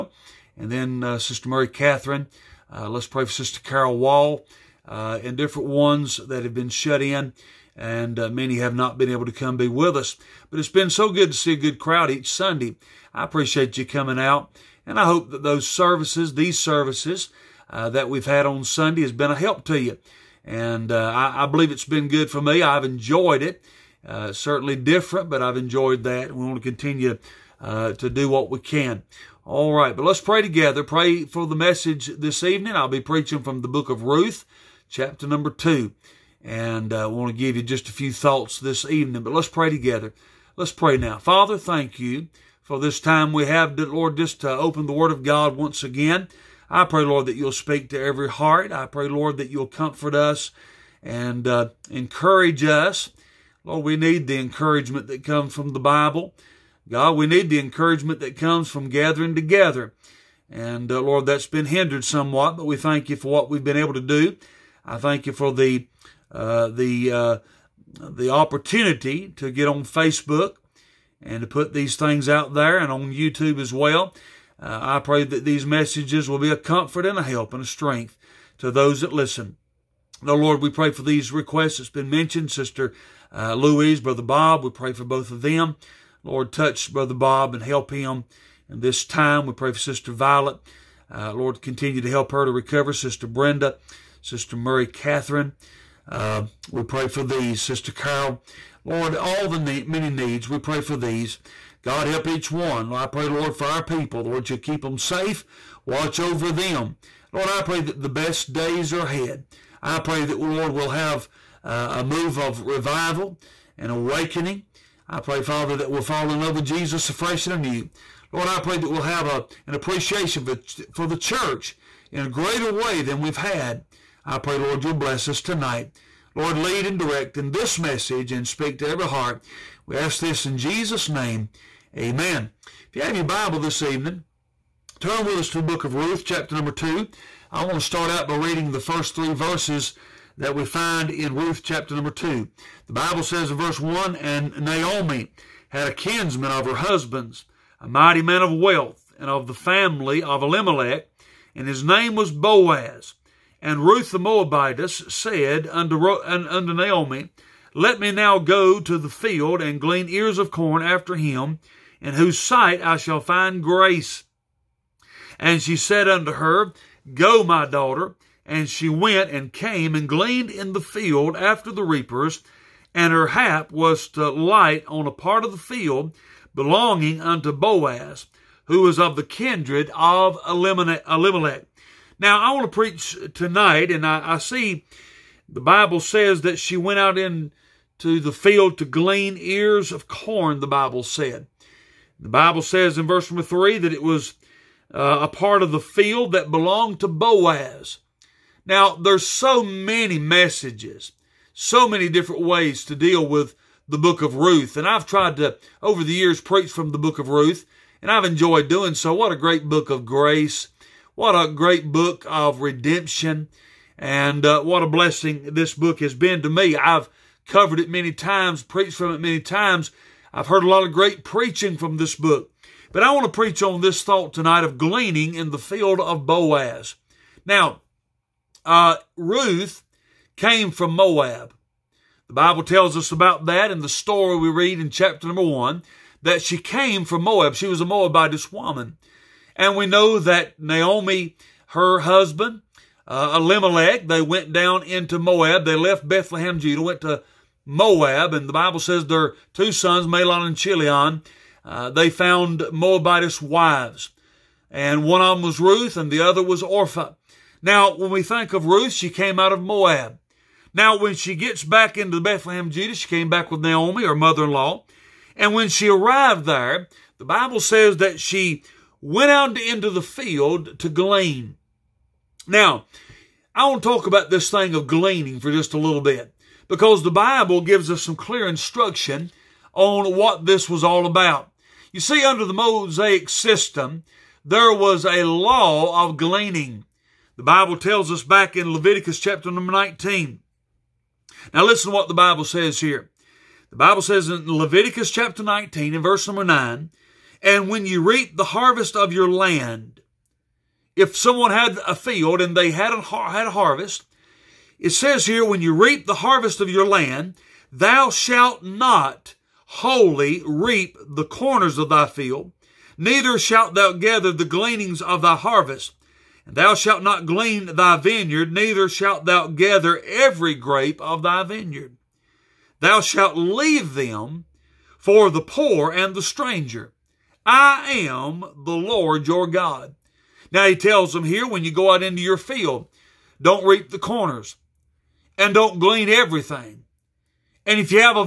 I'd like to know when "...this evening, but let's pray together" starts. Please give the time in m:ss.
0:38.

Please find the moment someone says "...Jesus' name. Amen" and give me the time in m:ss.
2:10.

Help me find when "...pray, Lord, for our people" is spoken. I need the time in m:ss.
1:43.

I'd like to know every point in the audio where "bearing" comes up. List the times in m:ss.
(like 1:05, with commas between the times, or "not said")
not said.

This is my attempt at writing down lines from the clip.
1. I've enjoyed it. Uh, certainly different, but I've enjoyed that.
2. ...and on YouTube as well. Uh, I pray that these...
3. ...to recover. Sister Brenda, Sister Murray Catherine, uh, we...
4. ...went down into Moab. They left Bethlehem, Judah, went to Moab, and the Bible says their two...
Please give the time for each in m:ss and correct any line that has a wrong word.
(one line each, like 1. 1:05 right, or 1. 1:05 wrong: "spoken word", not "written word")
1. 0:22 right
2. 1:12 right
3. 1:32 right
4. 4:04 right.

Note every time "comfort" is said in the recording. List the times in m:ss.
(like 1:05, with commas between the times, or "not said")
0:49, 1:16.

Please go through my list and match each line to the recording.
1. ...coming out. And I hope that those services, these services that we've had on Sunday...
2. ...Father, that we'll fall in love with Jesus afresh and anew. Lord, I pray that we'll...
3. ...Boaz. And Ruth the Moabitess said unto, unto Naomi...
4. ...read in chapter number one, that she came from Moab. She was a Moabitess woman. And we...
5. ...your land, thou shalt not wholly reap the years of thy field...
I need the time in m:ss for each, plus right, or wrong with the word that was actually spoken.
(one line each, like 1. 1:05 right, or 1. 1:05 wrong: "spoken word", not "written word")
1. 0:13 right
2. 1:55 right
3. 2:32 right
4. 3:54 right
5. 5:06 wrong: "corners", not "years".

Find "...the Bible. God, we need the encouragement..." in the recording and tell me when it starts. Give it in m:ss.
0:55.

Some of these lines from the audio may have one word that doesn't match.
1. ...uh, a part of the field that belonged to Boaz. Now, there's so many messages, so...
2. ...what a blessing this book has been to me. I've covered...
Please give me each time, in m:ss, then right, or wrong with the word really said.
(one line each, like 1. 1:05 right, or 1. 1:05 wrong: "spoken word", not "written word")
1. 3:14 right
2. 3:34 right.